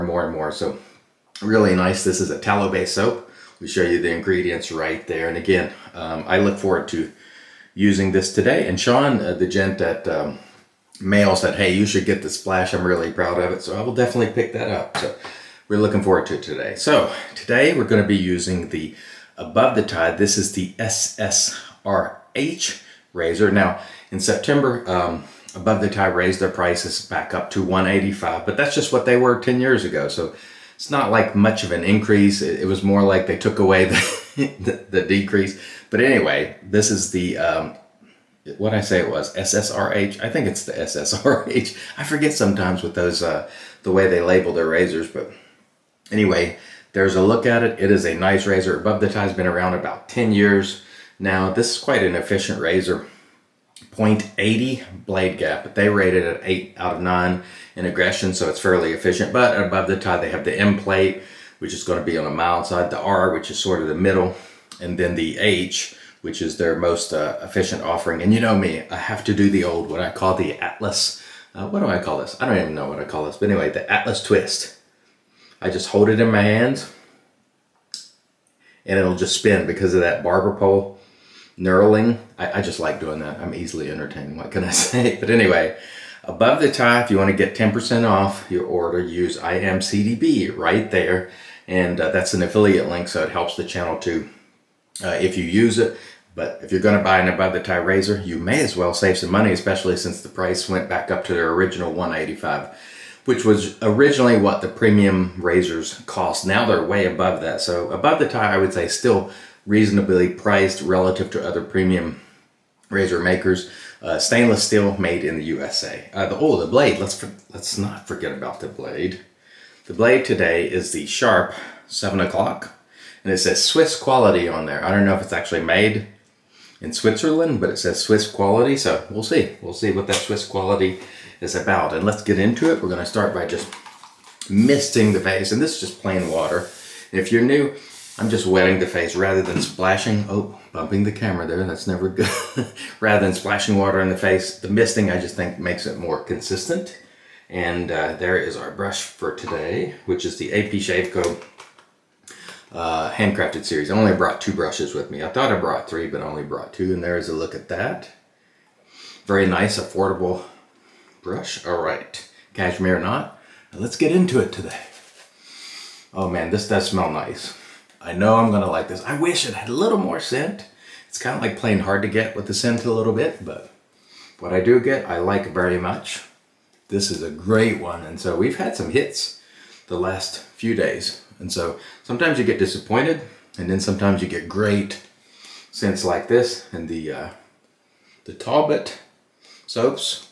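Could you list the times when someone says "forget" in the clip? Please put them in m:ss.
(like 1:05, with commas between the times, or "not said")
0:42, 1:58.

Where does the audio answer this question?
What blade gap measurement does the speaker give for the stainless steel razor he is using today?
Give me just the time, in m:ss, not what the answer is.
0:53.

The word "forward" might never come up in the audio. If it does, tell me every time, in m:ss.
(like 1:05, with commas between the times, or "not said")
0:06, 0:16.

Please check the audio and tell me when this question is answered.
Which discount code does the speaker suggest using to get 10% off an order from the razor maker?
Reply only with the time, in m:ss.
1:29.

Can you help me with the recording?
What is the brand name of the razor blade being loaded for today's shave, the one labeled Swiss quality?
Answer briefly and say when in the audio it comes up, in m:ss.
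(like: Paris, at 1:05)
Sharp 7 o'clock, at 2:01.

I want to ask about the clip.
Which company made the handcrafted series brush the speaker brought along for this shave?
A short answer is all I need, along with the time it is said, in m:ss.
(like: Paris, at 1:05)
AP Shave Co, at 2:30.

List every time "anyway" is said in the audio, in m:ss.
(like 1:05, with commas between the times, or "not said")
0:36, 0:46, 1:13, 1:25.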